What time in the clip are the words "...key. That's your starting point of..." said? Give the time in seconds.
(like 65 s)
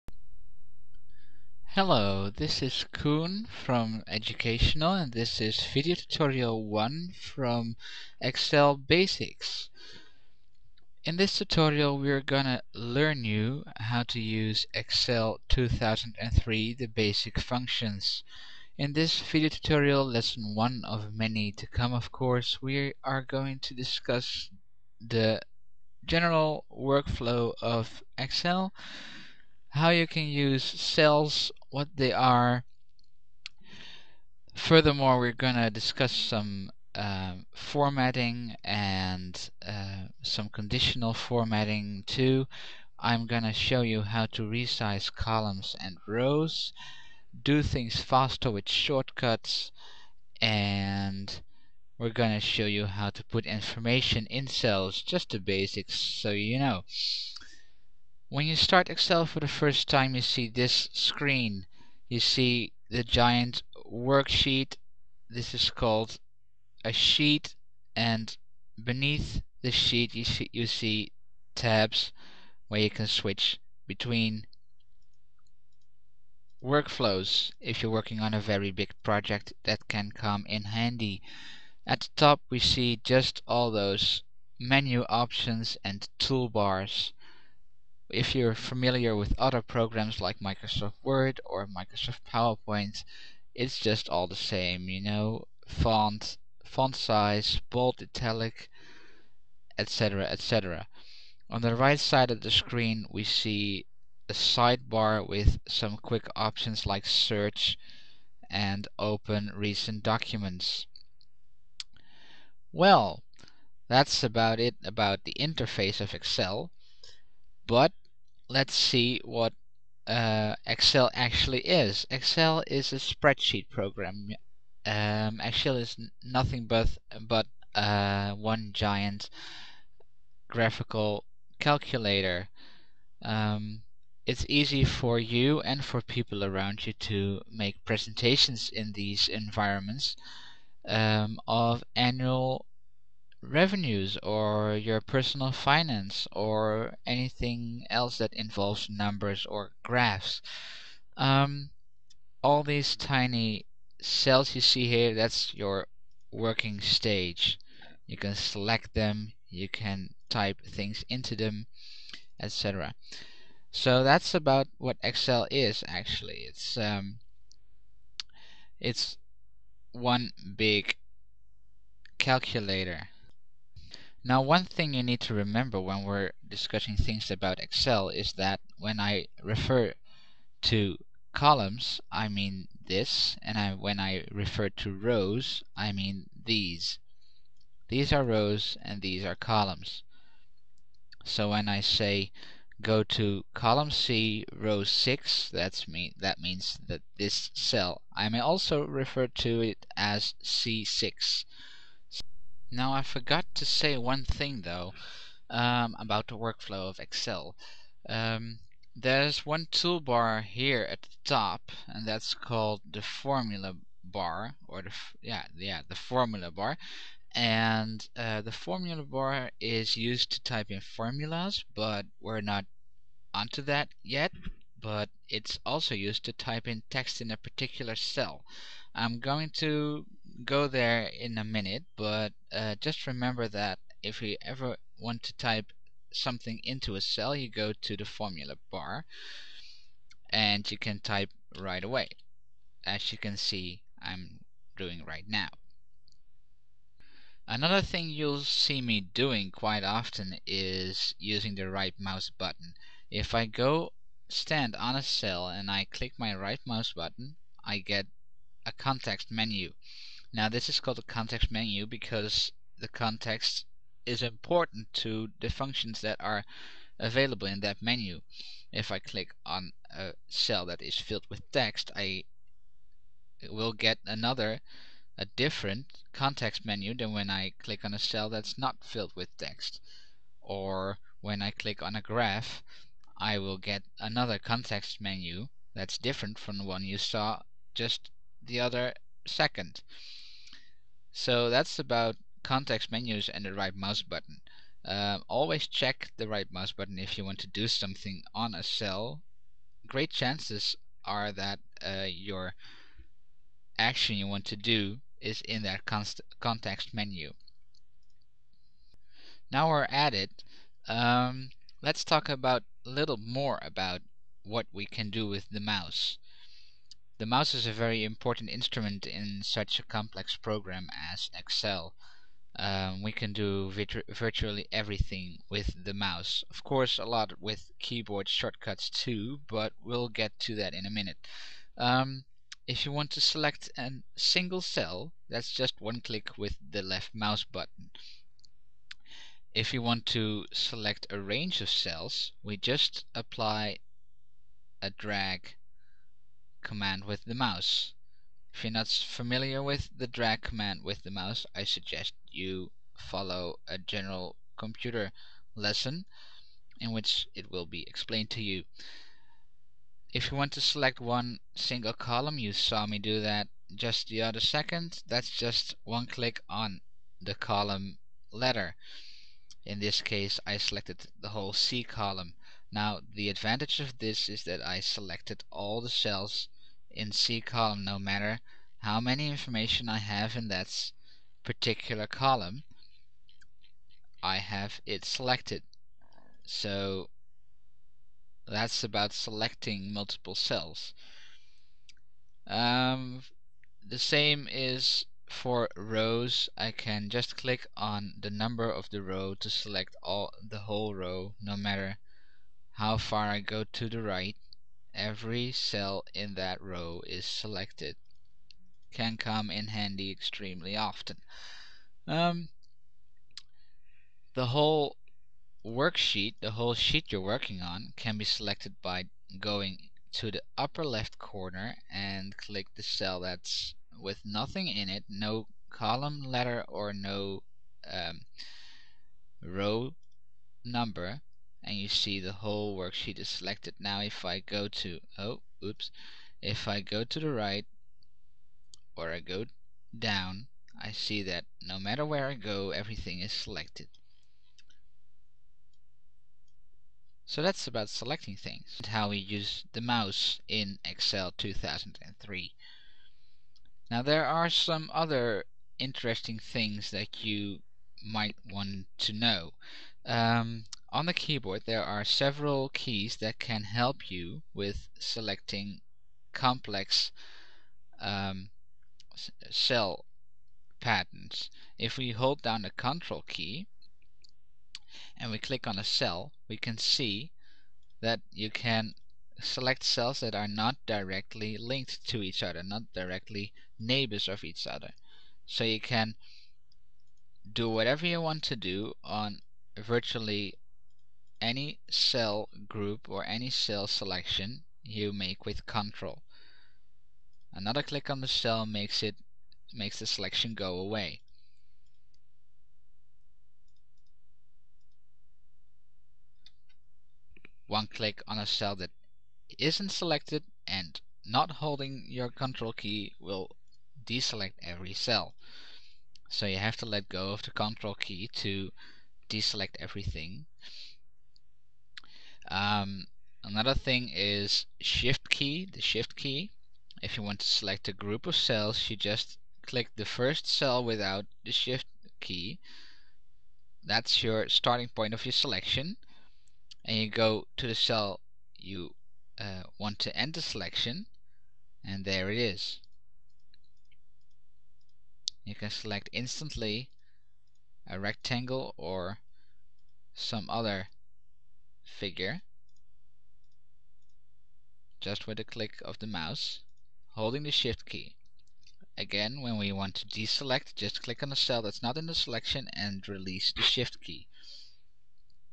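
532 s.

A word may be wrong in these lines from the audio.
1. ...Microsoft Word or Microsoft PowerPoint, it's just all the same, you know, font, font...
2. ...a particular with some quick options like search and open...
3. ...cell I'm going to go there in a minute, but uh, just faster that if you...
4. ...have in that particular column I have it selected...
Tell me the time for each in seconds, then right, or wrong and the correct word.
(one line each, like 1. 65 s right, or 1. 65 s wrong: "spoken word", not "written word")
1. 90 s right
2. 104 s wrong: "sidebar", not "particular"
3. 227 s wrong: "remember", not "faster"
4. 379 s right.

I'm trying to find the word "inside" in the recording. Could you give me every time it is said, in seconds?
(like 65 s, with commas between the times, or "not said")
not said.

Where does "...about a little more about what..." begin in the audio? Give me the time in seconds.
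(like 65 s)
312 s.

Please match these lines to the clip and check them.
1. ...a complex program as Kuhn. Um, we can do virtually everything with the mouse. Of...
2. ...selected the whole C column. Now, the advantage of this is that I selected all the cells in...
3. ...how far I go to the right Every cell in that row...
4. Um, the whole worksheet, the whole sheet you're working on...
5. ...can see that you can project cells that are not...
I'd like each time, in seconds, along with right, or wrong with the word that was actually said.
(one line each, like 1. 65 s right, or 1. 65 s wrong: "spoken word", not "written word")
1. 319 s wrong: "Excel", not "Kuhn"
2. 370 s right
3. 402 s right
4. 412 s right
5. 476 s wrong: "select", not "project".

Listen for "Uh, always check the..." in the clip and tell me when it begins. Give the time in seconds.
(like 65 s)
294 s.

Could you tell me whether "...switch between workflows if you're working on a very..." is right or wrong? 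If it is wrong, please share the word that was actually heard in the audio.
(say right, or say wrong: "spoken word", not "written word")
right.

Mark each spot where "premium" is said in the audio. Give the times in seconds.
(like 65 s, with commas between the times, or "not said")
not said.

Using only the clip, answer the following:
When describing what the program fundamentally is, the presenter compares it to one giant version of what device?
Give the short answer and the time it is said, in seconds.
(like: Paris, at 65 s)
graphical calculator, at 130 s.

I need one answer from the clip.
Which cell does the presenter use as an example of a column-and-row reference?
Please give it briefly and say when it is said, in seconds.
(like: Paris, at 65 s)
C6, at 200 s.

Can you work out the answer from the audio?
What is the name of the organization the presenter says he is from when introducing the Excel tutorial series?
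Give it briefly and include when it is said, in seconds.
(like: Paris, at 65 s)
EducationALL, at 4 s.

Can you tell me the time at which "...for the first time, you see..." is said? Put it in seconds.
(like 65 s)
59 s.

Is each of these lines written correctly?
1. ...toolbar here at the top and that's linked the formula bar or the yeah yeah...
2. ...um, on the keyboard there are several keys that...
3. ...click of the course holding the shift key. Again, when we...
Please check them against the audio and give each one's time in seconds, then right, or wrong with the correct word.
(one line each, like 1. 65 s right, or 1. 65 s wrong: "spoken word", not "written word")
1. 209 s wrong: "called", not "linked"
2. 460 s right
3. 555 s wrong: "mouse", not "course".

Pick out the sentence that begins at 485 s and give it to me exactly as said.
So you can do whatever you want to do on virtually any cell group or any cell selection you make with control.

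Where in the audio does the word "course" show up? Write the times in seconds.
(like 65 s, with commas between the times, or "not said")
22 s, 326 s.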